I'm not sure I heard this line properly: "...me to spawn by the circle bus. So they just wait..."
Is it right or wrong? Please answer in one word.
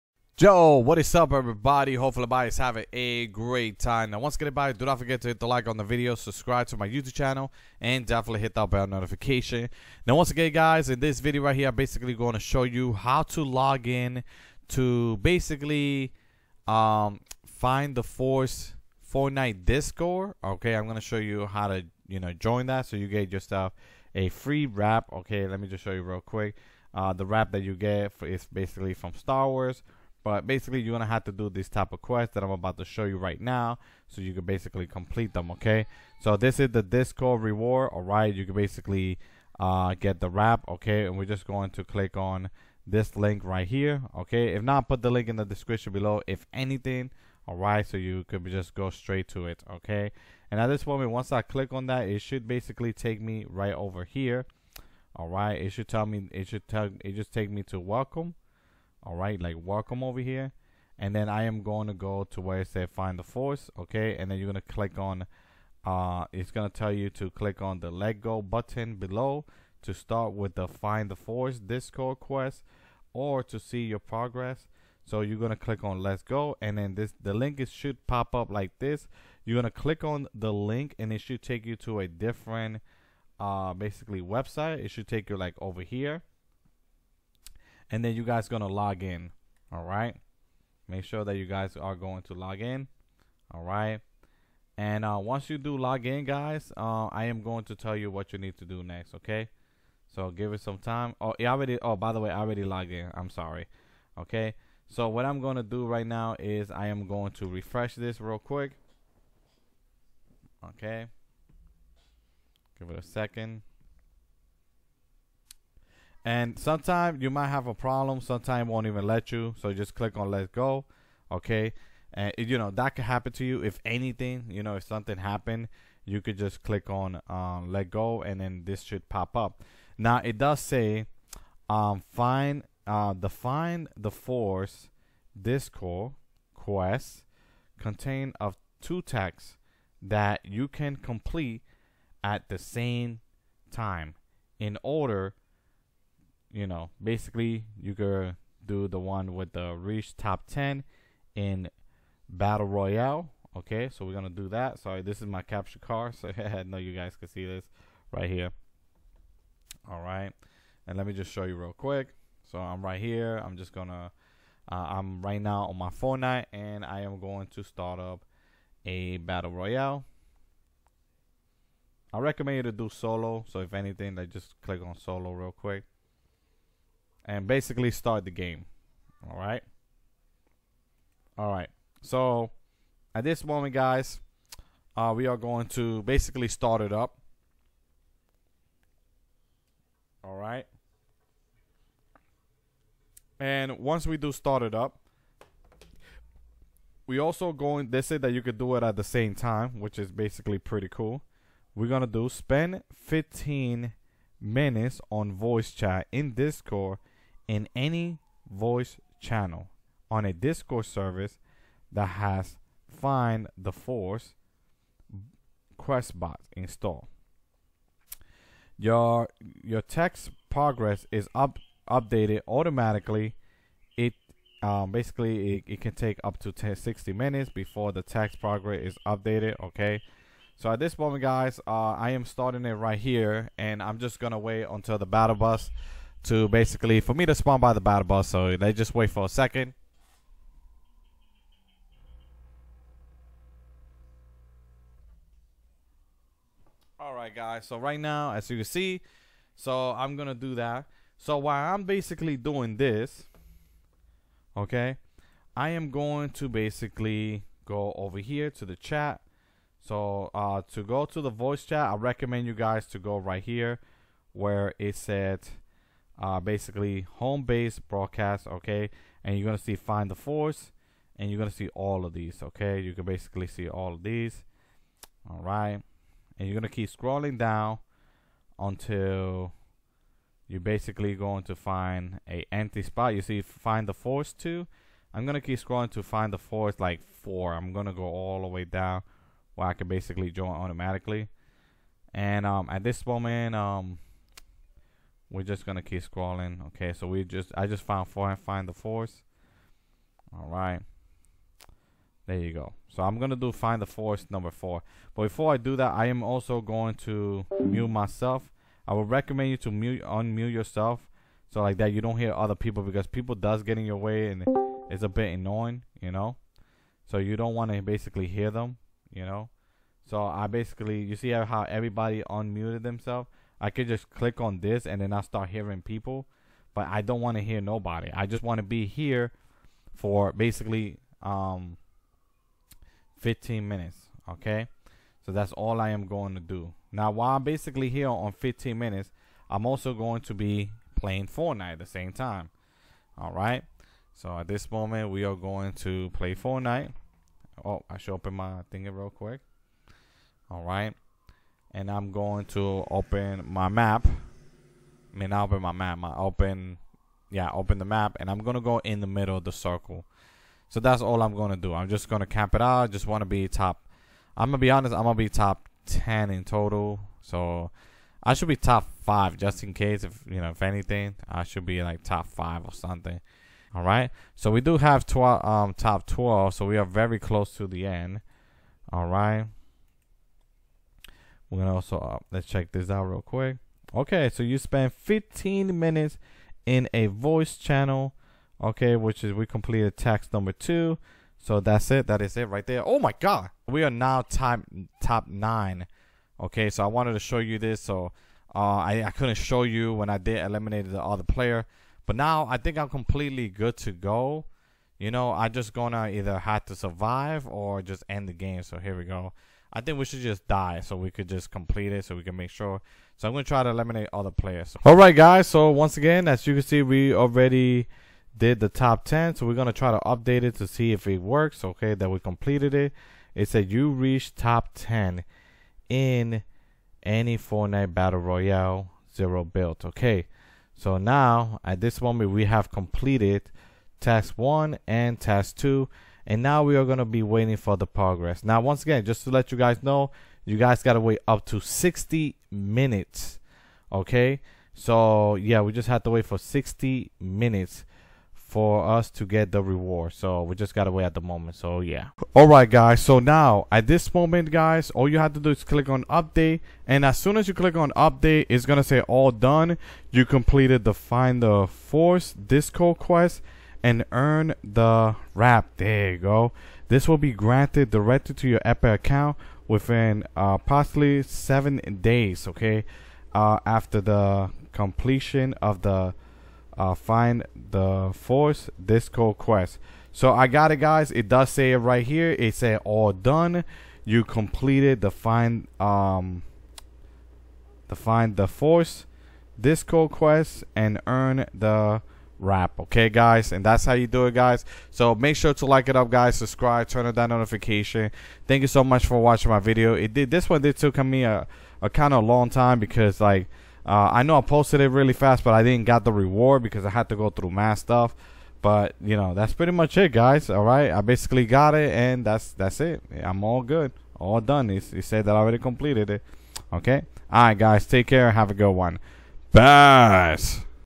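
wrong.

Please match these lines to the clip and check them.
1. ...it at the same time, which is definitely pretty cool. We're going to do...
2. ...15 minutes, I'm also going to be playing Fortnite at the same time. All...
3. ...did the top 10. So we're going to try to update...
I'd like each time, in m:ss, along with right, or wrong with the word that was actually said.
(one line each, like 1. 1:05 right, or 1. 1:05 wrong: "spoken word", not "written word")
1. 3:18 wrong: "basically", not "definitely"
2. 5:38 right
3. 6:58 right.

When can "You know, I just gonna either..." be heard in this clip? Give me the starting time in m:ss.
6:44.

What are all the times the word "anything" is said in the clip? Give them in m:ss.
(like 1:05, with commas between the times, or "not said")
0:46, 2:03, 2:53, 6:10.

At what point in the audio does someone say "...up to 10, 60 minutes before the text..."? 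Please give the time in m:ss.
3:46.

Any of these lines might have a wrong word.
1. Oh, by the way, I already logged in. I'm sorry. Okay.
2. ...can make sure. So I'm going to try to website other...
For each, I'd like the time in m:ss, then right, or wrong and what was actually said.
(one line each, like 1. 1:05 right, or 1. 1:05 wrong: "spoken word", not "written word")
1. 1:41 right
2. 6:52 wrong: "eliminate", not "website".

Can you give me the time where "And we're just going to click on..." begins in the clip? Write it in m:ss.
0:41.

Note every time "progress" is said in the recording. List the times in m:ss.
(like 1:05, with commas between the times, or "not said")
1:13, 3:40, 3:48, 7:17.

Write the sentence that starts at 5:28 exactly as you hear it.
I just want to be here for basically um 15 minutes, okay?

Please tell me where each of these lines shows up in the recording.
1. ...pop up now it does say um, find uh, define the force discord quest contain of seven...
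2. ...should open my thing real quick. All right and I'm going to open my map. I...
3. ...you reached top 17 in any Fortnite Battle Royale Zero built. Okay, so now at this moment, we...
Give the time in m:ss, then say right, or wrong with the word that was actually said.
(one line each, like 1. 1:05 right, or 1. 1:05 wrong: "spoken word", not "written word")
1. 2:09 wrong: "two", not "seven"
2. 5:47 right
3. 7:03 wrong: "10", not "17".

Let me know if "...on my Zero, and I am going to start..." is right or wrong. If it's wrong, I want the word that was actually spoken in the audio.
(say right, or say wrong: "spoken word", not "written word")
wrong: "Fortnite", not "Zero".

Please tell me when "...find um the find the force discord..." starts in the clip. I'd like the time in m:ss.
8:05.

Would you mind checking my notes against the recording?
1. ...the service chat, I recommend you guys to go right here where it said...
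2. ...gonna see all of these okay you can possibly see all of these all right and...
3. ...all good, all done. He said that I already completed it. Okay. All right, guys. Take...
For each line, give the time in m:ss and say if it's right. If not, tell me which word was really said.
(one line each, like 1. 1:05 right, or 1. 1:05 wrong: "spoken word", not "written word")
1. 4:21 wrong: "voice", not "service"
2. 4:31 wrong: "basically", not "possibly"
3. 8:33 right.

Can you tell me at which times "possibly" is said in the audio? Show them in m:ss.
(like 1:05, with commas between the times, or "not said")
7:50.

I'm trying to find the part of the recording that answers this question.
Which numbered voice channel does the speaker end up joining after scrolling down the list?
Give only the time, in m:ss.
5:03.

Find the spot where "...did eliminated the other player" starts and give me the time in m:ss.
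6:40.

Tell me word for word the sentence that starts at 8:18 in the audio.
Thank you so much for watching my video.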